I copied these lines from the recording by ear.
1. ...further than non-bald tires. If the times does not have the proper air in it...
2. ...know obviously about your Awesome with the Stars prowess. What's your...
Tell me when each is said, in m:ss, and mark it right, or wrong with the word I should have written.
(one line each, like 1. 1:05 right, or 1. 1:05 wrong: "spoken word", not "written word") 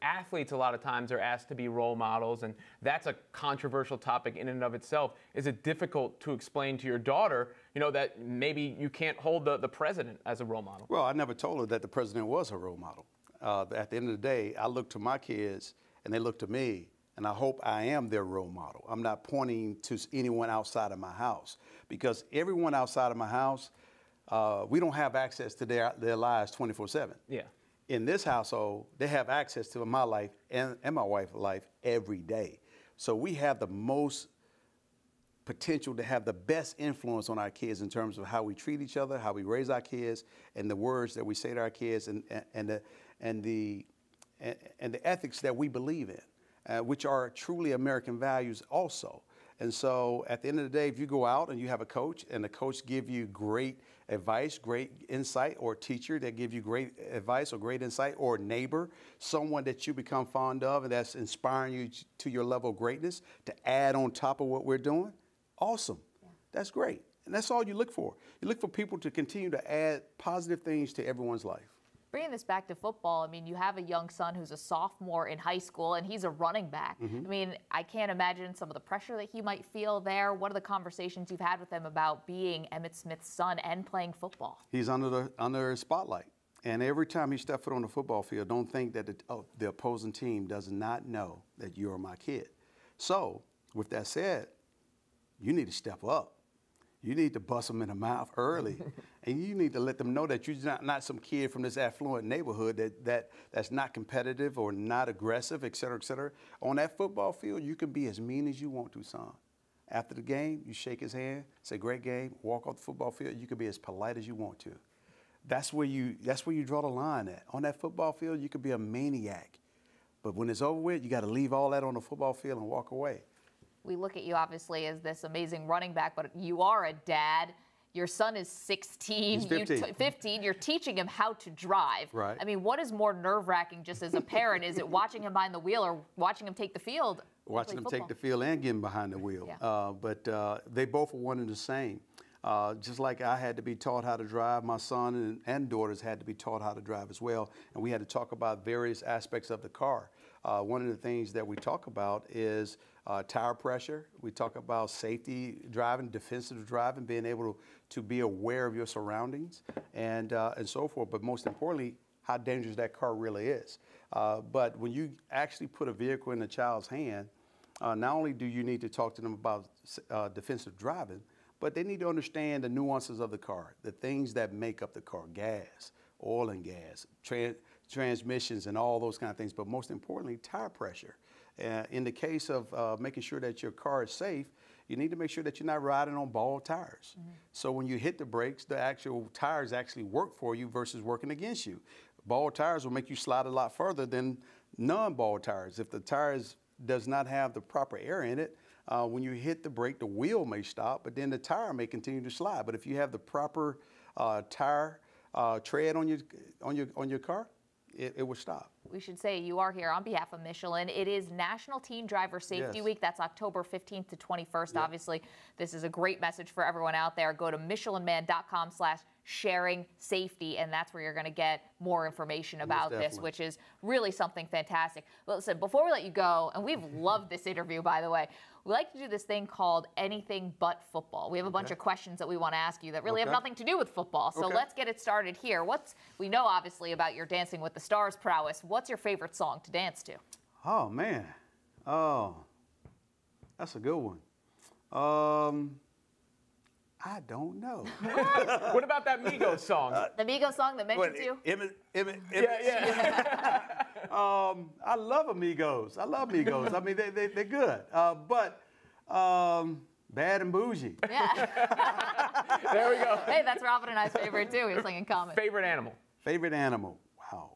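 1. 3:13 wrong: "tires", not "times"
2. 3:56 wrong: "Dancing", not "Awesome".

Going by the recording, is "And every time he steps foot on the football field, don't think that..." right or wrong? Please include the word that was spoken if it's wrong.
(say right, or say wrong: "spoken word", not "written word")
right.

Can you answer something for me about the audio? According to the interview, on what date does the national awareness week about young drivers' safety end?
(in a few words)
October 21.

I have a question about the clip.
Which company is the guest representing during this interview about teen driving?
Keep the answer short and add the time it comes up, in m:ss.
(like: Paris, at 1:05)
Michelin, at 3:30.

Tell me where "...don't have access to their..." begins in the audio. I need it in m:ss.
0:24.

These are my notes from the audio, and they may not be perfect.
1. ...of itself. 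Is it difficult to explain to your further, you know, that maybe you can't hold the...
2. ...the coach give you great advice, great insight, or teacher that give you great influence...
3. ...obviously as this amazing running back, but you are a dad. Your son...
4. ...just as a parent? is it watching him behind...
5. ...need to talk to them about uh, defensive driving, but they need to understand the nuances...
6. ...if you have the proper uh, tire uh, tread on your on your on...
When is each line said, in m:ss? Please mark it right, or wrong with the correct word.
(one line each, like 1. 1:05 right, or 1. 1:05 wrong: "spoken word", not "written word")
1. 0:04 wrong: "daughter", not "further"
2. 0:52 wrong: "advice", not "influence"
3. 2:04 right
4. 2:13 right
5. 2:48 right
6. 3:22 right.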